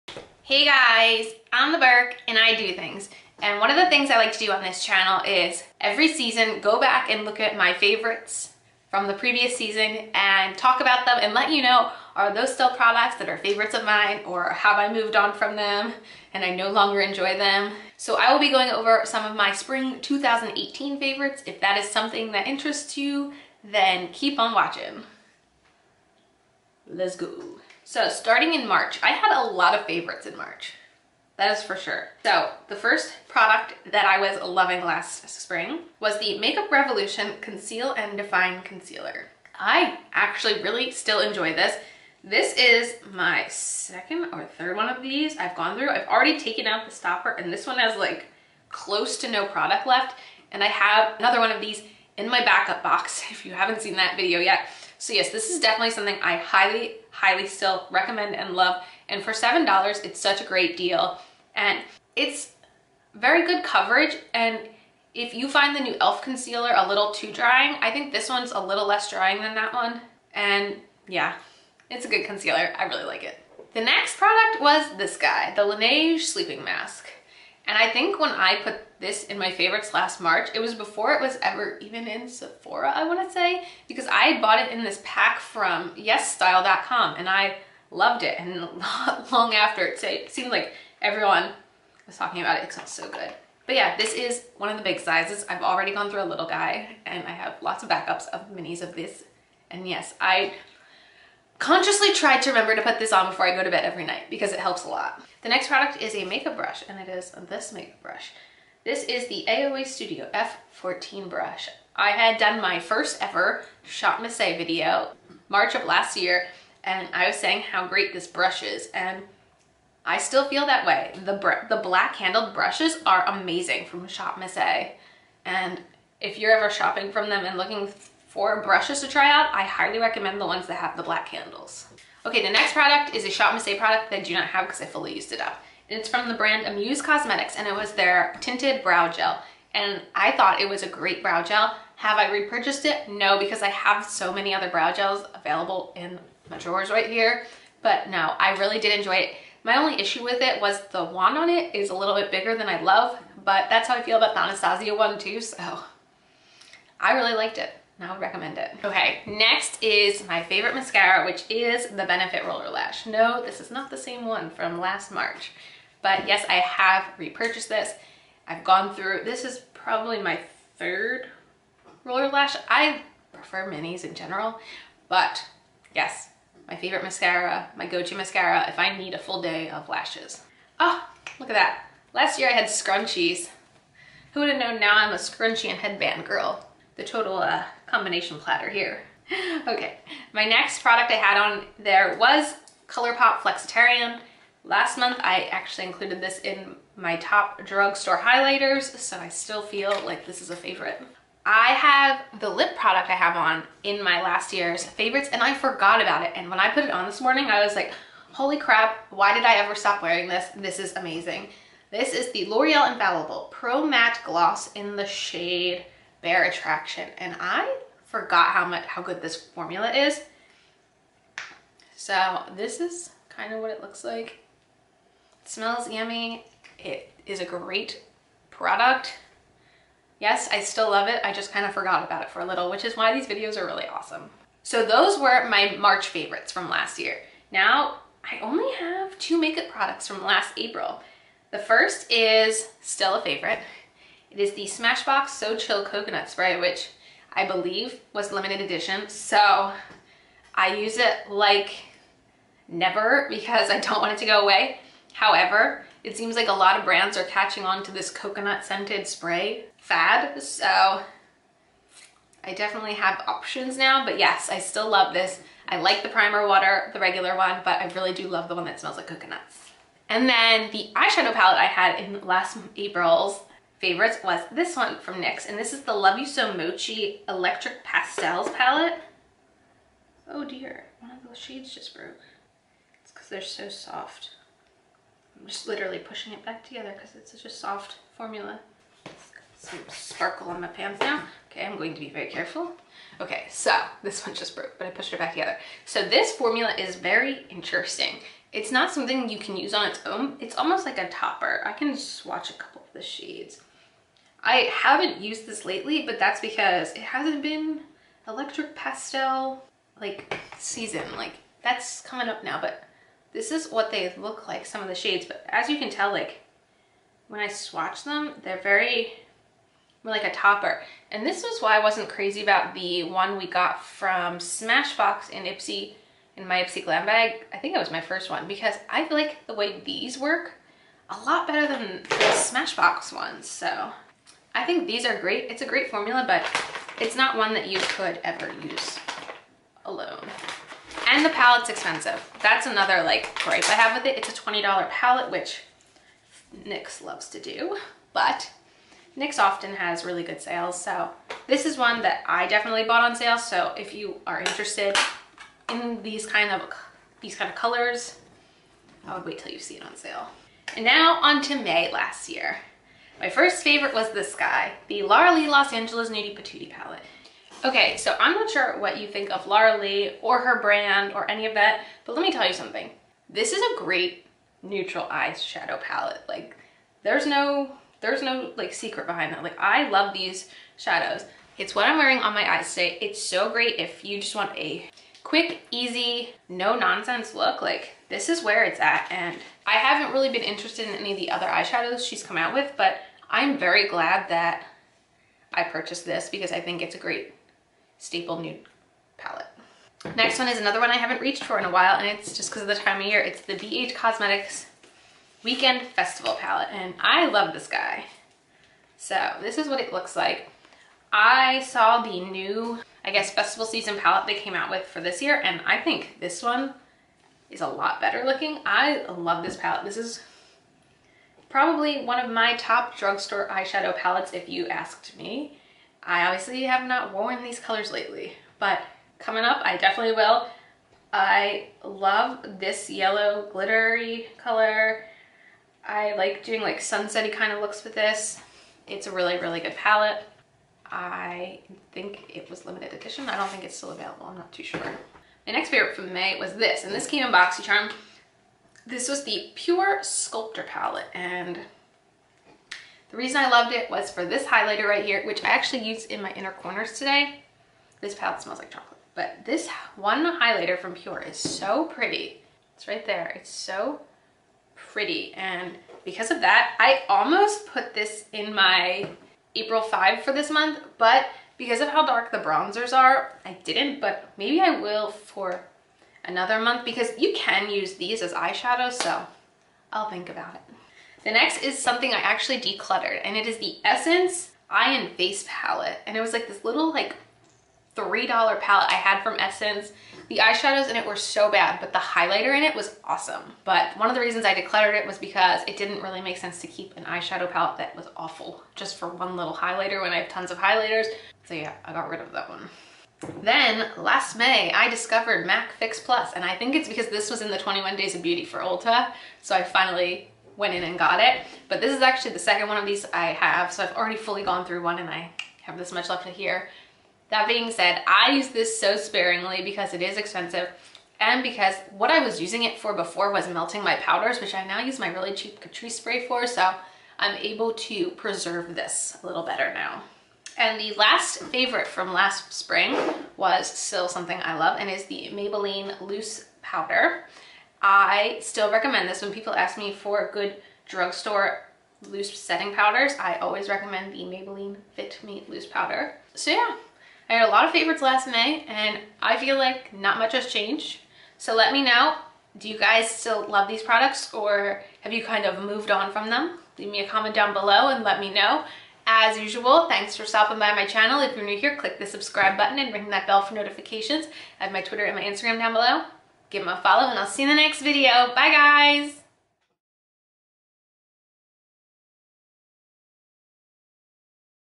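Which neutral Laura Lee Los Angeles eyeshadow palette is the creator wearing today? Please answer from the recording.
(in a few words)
Nudie Patootie.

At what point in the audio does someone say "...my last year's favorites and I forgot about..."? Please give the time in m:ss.
3:24.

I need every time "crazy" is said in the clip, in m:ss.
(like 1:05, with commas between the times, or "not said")
5:22.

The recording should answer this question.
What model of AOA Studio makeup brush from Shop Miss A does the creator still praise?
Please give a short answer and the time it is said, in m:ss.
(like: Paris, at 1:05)
F14, at 1:50.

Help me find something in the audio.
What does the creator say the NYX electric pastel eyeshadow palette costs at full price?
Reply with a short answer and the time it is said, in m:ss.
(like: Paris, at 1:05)
$20, at 5:44.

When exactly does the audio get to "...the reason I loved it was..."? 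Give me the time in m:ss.
7:33.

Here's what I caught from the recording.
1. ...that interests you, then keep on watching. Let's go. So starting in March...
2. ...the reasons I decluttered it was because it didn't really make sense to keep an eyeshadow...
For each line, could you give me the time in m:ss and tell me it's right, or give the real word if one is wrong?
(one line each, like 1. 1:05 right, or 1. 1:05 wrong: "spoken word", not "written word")
1. 0:22 right
2. 8:14 right.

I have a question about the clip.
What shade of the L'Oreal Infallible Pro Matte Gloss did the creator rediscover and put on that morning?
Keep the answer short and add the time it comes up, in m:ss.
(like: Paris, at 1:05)
Bare Attraction, at 3:36.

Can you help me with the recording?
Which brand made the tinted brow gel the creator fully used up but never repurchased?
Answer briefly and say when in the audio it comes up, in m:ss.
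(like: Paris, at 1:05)
Amuse Cosmetics, at 2:16.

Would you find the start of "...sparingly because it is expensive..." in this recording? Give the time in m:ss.
8:38.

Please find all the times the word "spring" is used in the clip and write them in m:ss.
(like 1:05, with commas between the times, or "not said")
0:19, 0:35, 8:52.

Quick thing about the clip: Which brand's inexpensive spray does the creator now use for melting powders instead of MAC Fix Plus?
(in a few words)
Catrice.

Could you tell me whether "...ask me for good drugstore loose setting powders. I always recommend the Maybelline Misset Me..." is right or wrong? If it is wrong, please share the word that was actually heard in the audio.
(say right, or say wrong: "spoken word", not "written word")
wrong: "Fit", not "Misset".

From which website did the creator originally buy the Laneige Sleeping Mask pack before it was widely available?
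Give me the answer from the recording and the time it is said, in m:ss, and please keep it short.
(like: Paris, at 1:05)
yesstyle.com, at 1:25.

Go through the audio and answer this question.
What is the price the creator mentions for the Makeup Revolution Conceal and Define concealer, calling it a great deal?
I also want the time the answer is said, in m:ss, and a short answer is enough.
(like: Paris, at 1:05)
$7, at 0:59.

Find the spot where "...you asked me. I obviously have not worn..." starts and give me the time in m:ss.
7:04.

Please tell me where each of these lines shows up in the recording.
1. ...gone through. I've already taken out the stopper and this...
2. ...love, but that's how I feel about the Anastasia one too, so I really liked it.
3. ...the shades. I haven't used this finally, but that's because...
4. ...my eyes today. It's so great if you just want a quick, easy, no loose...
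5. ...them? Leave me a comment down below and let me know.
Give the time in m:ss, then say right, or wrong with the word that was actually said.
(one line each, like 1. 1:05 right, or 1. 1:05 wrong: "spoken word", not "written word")
1. 0:45 right
2. 2:32 right
3. 5:02 wrong: "lately", not "finally"
4. 6:22 wrong: "nonsense", not "loose"
5. 9:16 right.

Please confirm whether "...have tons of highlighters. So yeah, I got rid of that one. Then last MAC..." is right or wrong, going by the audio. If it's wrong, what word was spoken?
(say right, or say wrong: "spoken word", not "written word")
wrong: "May", not "MAC".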